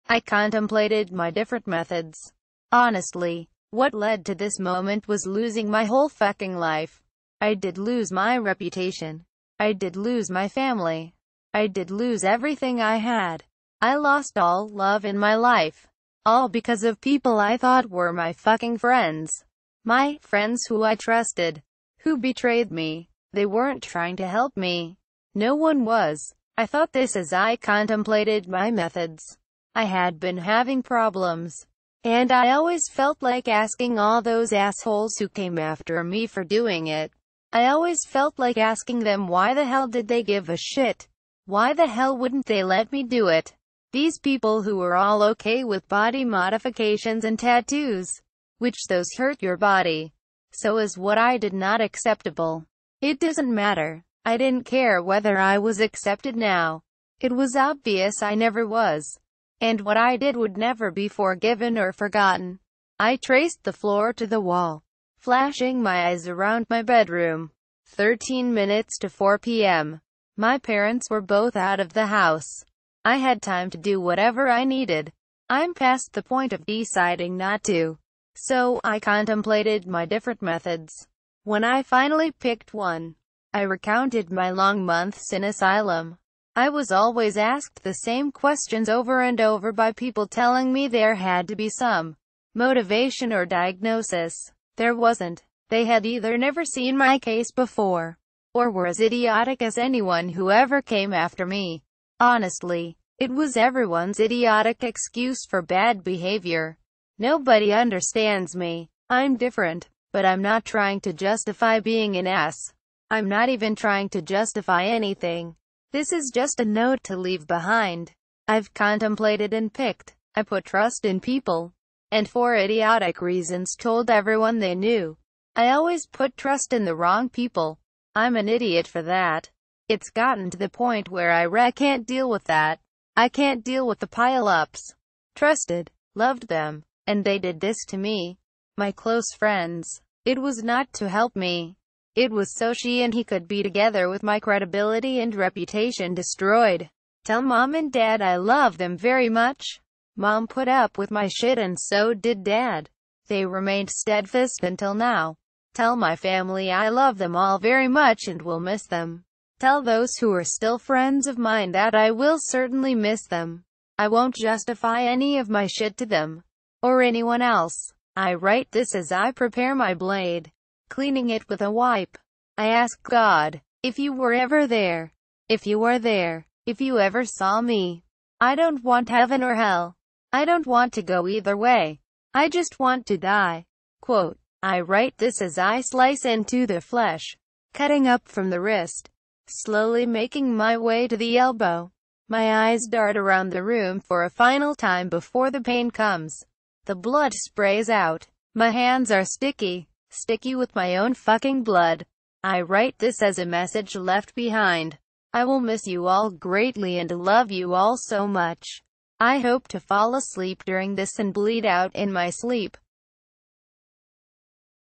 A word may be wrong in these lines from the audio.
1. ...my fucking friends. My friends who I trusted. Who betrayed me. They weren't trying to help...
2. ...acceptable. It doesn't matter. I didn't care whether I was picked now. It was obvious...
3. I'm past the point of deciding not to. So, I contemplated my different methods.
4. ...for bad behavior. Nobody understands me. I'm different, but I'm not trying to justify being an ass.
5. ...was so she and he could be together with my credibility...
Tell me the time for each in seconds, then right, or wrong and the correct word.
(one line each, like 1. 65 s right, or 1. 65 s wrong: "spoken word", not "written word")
1. 18 s right
2. 51 s wrong: "accepted", not "picked"
3. 75 s right
4. 105 s right
5. 142 s right.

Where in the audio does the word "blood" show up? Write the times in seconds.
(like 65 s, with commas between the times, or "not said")
196 s, 201 s.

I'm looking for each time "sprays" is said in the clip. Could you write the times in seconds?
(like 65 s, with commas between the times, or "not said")
197 s.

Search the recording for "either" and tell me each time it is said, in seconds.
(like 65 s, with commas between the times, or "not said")
96 s, 181 s.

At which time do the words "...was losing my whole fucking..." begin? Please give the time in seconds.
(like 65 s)
5 s.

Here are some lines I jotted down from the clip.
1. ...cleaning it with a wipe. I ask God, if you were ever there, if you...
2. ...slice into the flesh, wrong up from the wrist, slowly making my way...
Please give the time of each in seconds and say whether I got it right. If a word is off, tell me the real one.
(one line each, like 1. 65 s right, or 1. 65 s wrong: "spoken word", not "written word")
1. 170 s right
2. 185 s wrong: "cutting", not "wrong".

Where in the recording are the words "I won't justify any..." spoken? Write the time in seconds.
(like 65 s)
163 s.